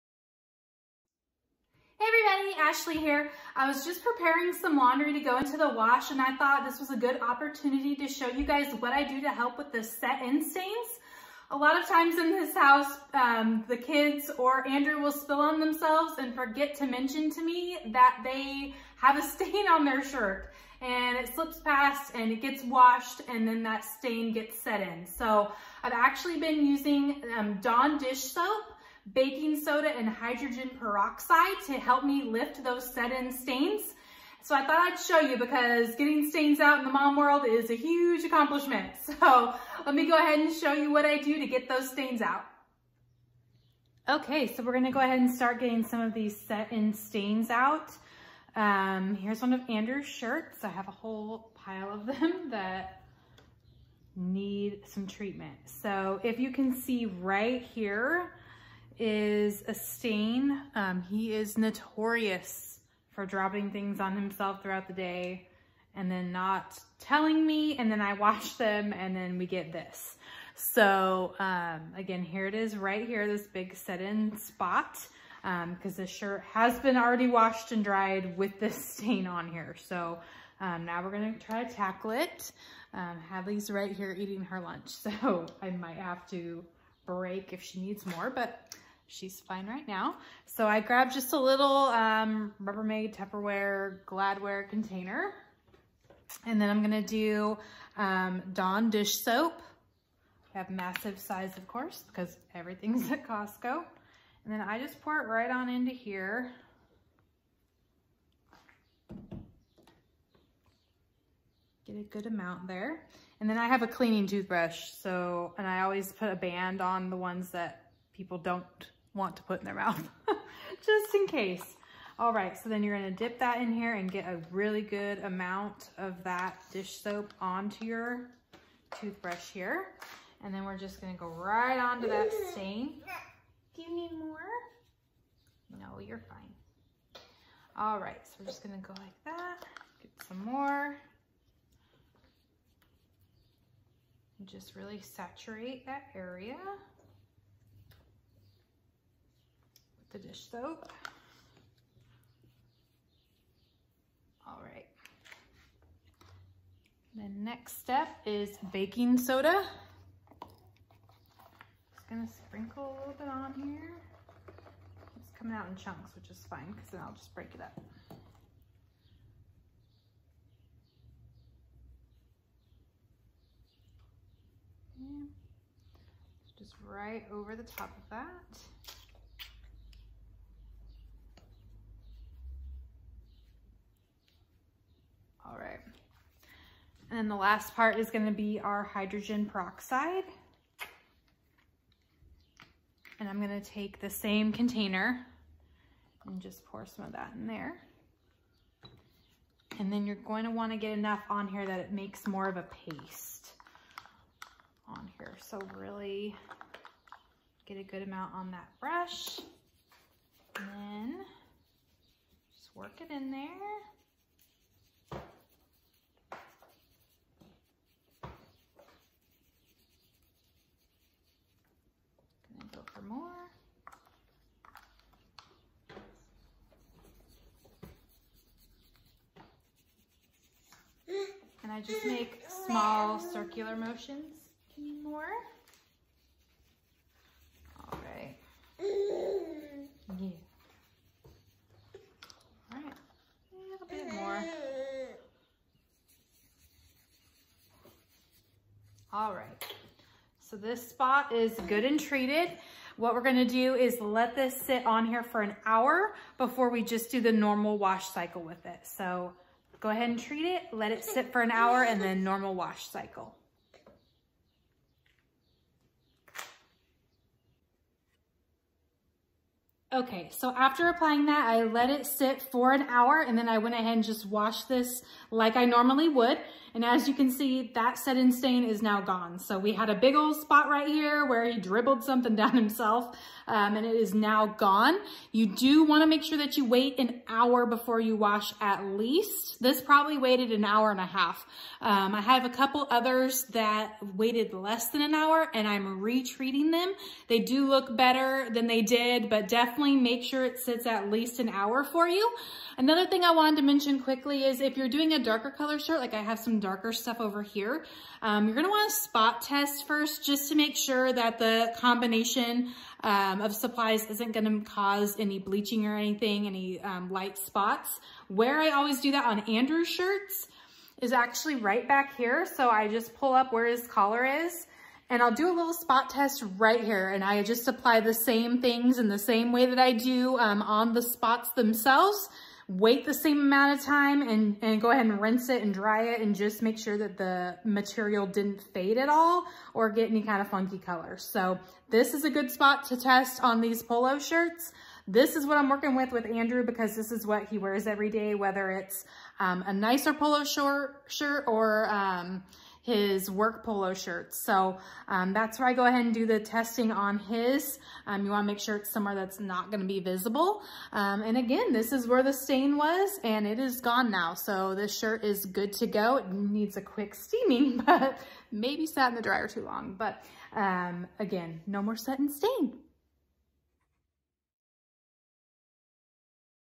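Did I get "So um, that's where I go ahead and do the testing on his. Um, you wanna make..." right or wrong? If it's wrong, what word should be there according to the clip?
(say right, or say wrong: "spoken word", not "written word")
right.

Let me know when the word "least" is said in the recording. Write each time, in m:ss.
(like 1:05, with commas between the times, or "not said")
4:48, 5:01.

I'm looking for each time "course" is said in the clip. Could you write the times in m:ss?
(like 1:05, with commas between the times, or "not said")
1:41.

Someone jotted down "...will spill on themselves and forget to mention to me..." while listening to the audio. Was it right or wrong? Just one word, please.
right.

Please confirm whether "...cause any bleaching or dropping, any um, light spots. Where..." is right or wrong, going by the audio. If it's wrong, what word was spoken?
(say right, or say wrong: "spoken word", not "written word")
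wrong: "anything", not "dropping".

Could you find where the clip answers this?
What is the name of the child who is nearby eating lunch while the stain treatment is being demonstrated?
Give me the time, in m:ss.
1:23.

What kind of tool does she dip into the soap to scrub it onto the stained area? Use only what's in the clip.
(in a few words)
cleaning toothbrush.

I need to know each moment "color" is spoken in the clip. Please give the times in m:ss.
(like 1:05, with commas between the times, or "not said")
5:05, 5:40.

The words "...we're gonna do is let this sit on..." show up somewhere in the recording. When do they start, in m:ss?
4:13.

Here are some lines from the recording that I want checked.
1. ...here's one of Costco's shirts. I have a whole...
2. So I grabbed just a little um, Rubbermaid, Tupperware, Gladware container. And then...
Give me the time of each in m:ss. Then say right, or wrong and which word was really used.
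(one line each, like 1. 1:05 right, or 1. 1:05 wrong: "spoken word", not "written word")
1. 0:49 wrong: "Andrew", not "Costco"
2. 1:30 right.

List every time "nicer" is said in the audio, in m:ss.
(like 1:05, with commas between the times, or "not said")
5:49.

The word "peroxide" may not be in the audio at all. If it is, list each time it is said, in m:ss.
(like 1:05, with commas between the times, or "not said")
0:30, 3:09.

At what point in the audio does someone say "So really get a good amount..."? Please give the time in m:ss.
3:25.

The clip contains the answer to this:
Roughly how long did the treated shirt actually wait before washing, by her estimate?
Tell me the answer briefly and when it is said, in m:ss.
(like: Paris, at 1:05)
an hour and a half, at 4:50.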